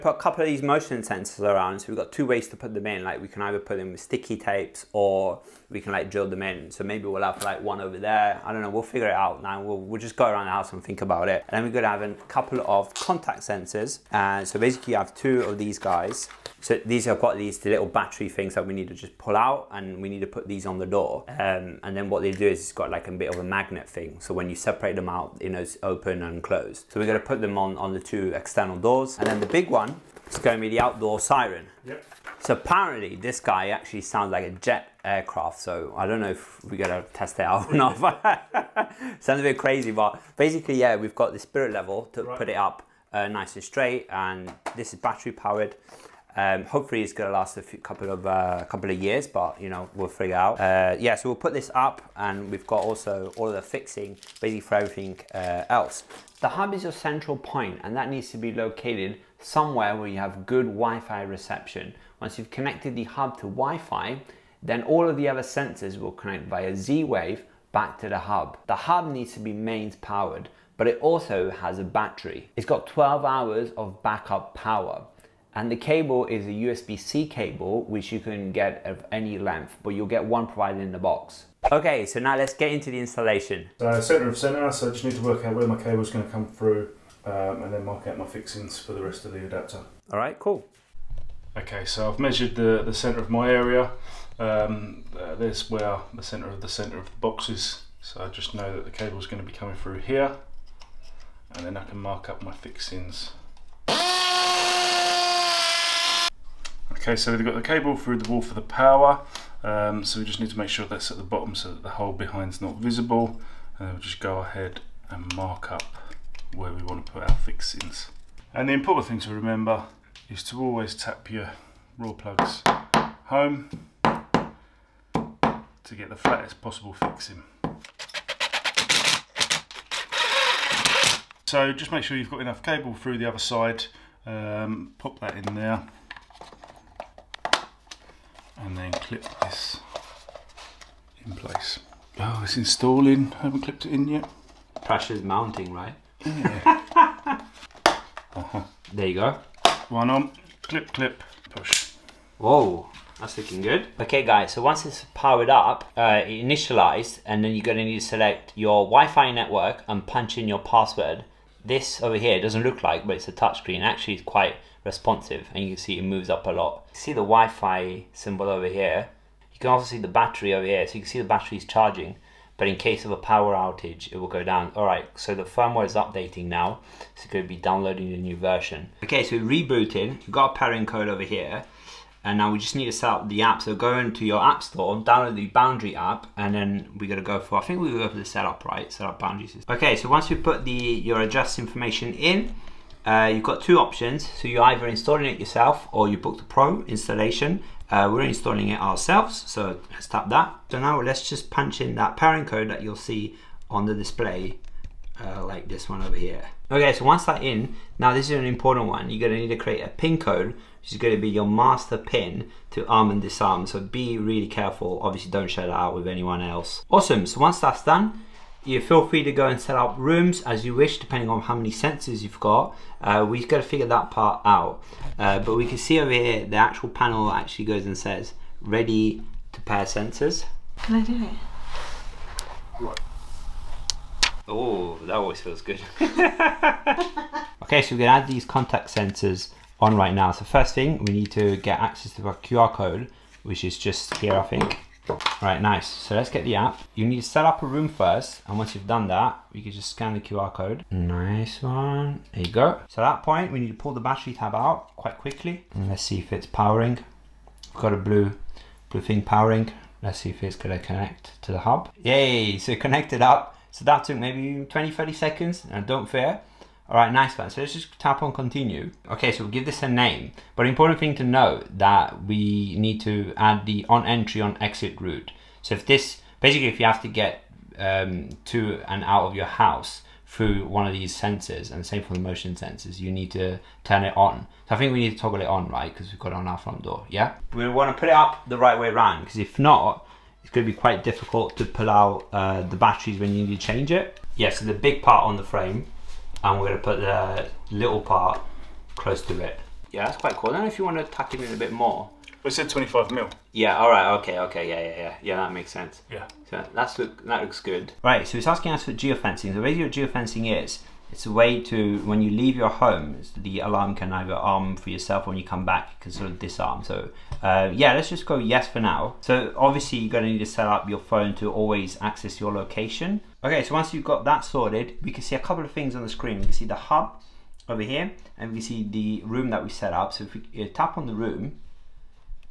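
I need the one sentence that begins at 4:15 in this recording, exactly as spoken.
And let's see if it's powering.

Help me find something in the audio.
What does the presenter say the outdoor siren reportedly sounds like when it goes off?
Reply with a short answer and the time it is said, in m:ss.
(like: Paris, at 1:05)
A jet aircraft, at 0:34.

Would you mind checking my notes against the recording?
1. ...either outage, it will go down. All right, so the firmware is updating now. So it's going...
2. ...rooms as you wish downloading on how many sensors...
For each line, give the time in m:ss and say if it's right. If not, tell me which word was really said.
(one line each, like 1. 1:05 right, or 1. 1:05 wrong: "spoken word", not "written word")
1. 2:53 wrong: "power", not "either"
2. 3:39 wrong: "depending", not "downloading".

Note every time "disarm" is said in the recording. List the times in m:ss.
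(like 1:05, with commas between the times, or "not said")
3:33, 5:16.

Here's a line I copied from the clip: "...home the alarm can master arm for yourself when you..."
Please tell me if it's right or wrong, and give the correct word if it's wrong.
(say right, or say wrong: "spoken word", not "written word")
wrong: "either", not "master".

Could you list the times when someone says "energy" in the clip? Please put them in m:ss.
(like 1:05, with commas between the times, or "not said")
not said.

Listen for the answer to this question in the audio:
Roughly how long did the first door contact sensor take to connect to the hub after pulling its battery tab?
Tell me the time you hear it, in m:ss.
4:24.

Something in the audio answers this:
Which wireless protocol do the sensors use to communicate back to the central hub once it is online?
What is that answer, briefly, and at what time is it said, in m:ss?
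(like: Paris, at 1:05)
Z-Wave, at 1:06.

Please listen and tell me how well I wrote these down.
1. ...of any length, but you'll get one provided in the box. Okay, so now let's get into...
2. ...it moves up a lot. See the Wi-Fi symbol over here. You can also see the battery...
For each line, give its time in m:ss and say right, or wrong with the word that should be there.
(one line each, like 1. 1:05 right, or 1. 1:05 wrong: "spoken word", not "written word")
1. 1:18 right
2. 2:45 right.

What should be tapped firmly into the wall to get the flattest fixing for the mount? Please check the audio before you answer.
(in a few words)
Rawlplugs.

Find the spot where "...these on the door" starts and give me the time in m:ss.
0:20.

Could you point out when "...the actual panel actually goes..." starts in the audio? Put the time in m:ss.
3:46.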